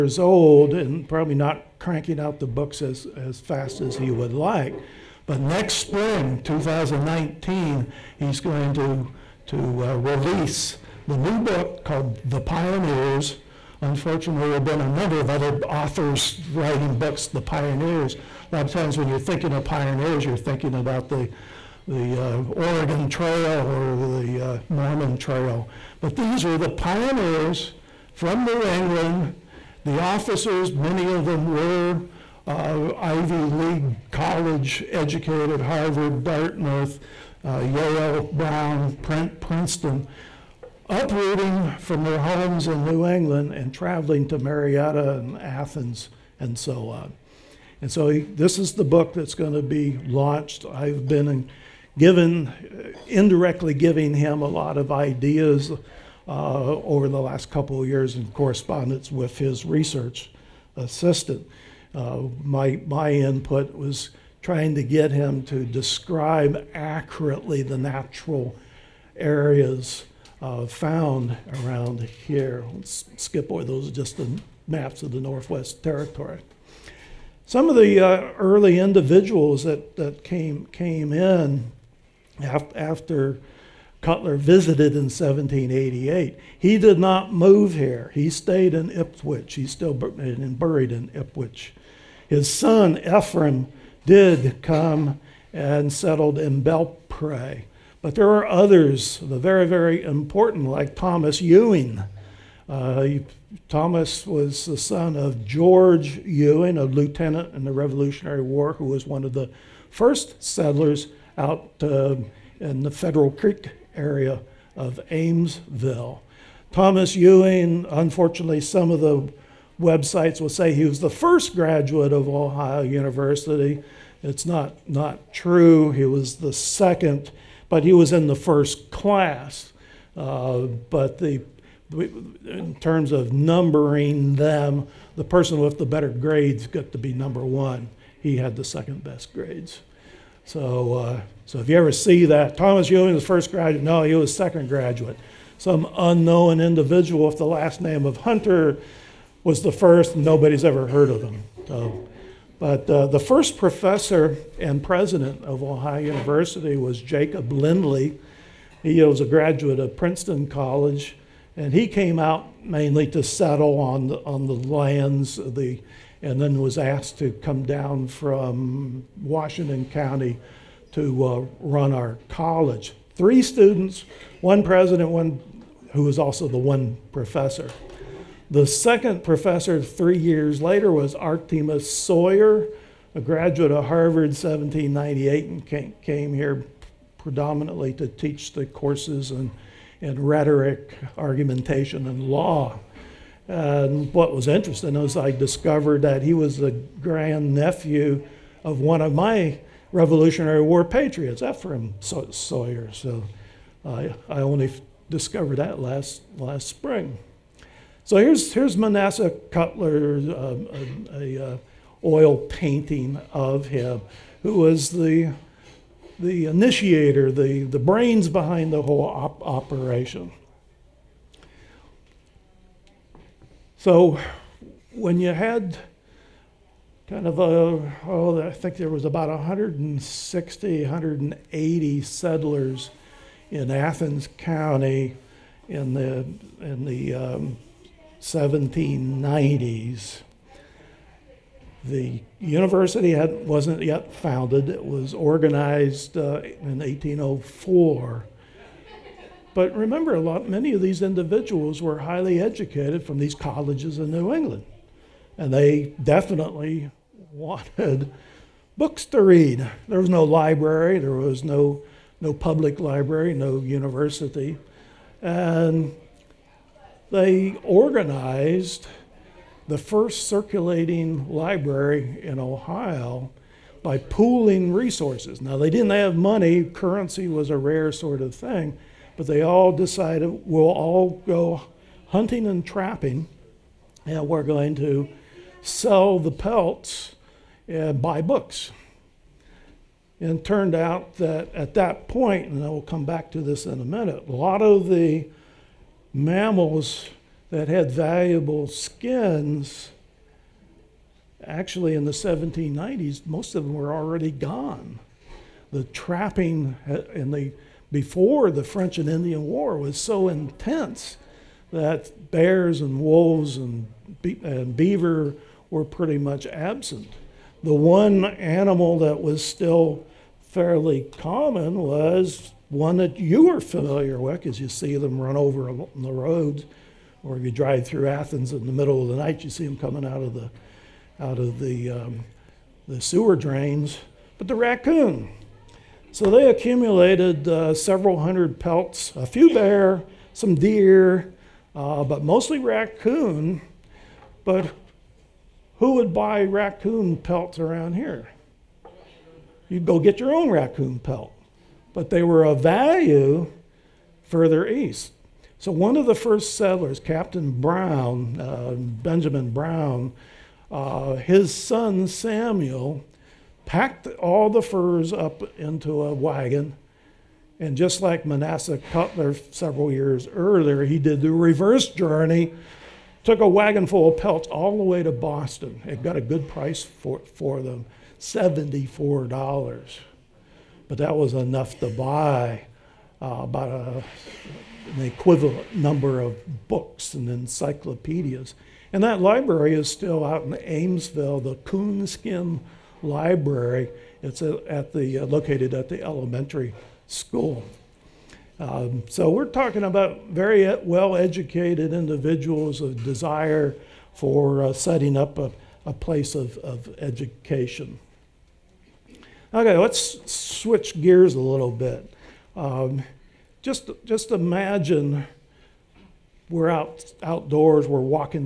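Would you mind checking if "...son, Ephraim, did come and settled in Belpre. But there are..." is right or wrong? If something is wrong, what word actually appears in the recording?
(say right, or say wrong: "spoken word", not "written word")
right.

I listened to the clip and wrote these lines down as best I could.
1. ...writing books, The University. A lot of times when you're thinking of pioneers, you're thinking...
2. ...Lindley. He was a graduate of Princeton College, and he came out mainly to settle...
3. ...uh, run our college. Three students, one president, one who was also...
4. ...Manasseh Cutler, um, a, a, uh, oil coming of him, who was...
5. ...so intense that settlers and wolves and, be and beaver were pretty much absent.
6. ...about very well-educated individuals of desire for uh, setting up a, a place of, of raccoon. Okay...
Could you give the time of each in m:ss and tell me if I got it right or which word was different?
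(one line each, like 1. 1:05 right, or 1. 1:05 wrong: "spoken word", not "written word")
1. 0:16 wrong: "Pioneers", not "University"
2. 2:37 right
3. 2:51 right
4. 3:28 wrong: "painting", not "coming"
5. 5:09 wrong: "bears", not "settlers"
6. 6:39 wrong: "education", not "raccoon".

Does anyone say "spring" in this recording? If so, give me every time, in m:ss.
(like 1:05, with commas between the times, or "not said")
0:05, 3:26.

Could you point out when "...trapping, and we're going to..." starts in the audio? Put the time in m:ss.
4:42.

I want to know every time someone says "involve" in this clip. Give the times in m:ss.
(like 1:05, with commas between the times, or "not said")
not said.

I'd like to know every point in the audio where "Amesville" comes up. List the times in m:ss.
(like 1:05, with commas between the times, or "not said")
1:55, 6:30.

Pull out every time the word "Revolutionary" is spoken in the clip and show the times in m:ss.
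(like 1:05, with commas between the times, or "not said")
1:47, 3:19.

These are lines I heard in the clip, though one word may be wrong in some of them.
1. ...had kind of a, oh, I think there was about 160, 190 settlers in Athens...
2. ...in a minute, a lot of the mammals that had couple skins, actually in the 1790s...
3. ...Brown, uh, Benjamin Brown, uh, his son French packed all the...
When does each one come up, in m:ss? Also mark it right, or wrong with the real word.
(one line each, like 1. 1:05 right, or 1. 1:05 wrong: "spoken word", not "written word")
1. 3:45 wrong: "180", not "190"
2. 4:53 wrong: "valuable", not "couple"
3. 5:57 wrong: "Samuel", not "French".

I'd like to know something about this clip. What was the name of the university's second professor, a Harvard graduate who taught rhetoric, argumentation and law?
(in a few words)
Artemus Sawyer.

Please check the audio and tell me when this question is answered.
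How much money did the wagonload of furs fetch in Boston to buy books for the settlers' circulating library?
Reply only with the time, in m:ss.
6:18.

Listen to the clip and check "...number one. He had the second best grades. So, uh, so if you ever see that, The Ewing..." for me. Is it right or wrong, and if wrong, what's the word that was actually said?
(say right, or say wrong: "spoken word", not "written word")
wrong: "Thomas", not "The".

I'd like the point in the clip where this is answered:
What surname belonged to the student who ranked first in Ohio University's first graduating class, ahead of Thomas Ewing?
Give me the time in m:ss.
2:28.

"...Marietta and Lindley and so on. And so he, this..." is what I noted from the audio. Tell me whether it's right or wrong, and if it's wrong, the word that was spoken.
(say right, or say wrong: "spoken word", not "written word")
wrong: "Athens", not "Lindley".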